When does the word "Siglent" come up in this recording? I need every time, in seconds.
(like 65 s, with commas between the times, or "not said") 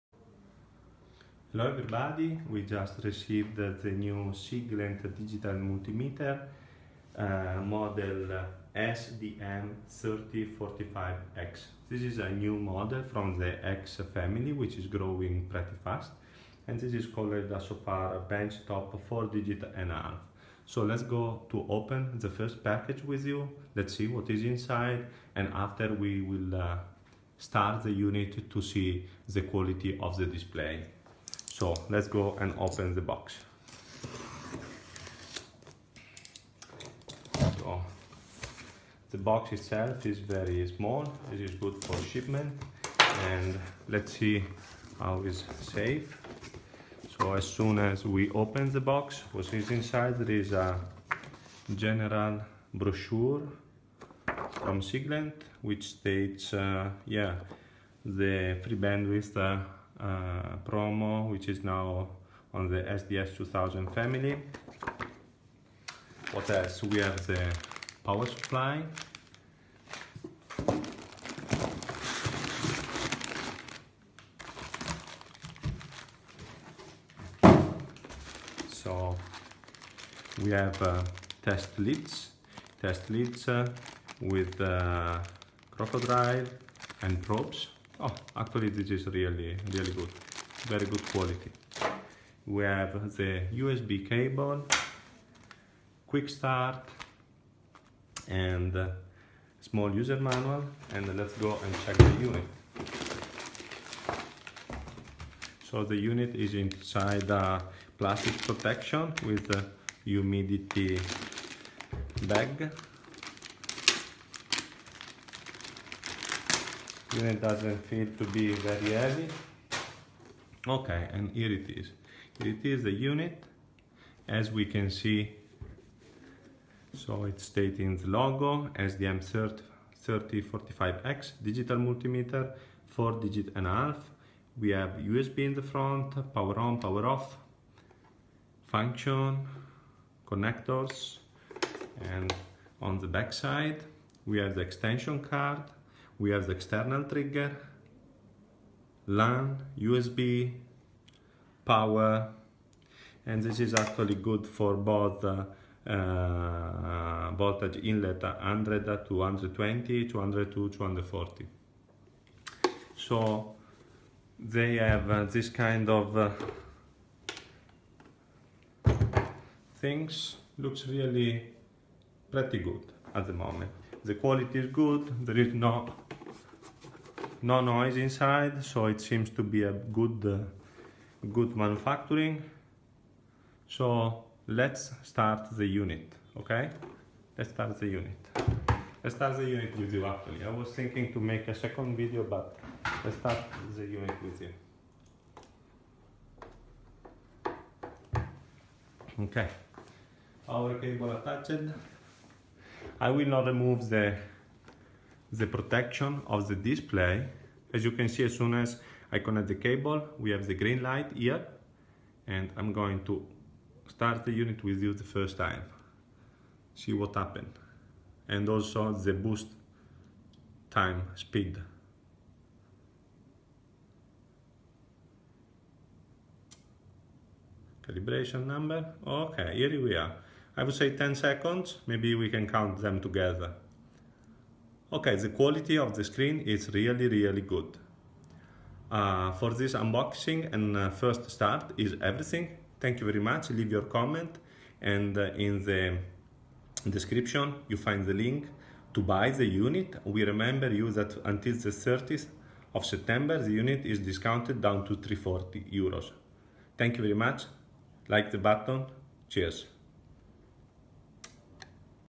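4 s, 54 s.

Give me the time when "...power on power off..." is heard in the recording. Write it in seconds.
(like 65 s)
136 s.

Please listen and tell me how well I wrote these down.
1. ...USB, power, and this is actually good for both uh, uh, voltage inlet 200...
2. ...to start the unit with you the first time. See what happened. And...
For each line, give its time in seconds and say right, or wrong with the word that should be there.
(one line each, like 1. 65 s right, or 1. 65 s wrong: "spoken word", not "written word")
1. 149 s wrong: "100", not "200"
2. 213 s right.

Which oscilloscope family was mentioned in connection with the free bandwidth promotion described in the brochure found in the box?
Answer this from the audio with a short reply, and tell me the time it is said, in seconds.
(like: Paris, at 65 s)
SDS 2000, at 62 s.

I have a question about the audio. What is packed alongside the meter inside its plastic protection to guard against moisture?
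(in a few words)
A humidity bag.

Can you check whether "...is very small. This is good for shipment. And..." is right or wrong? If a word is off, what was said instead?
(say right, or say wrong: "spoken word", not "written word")
right.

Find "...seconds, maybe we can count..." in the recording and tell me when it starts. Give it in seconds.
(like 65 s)
231 s.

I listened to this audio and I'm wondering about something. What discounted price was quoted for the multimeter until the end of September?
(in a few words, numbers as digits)
340 euros.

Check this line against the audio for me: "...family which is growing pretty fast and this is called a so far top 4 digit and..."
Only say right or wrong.
right.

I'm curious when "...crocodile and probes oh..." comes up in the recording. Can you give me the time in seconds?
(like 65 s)
85 s.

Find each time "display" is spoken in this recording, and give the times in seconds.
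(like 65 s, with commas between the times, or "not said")
30 s, 206 s.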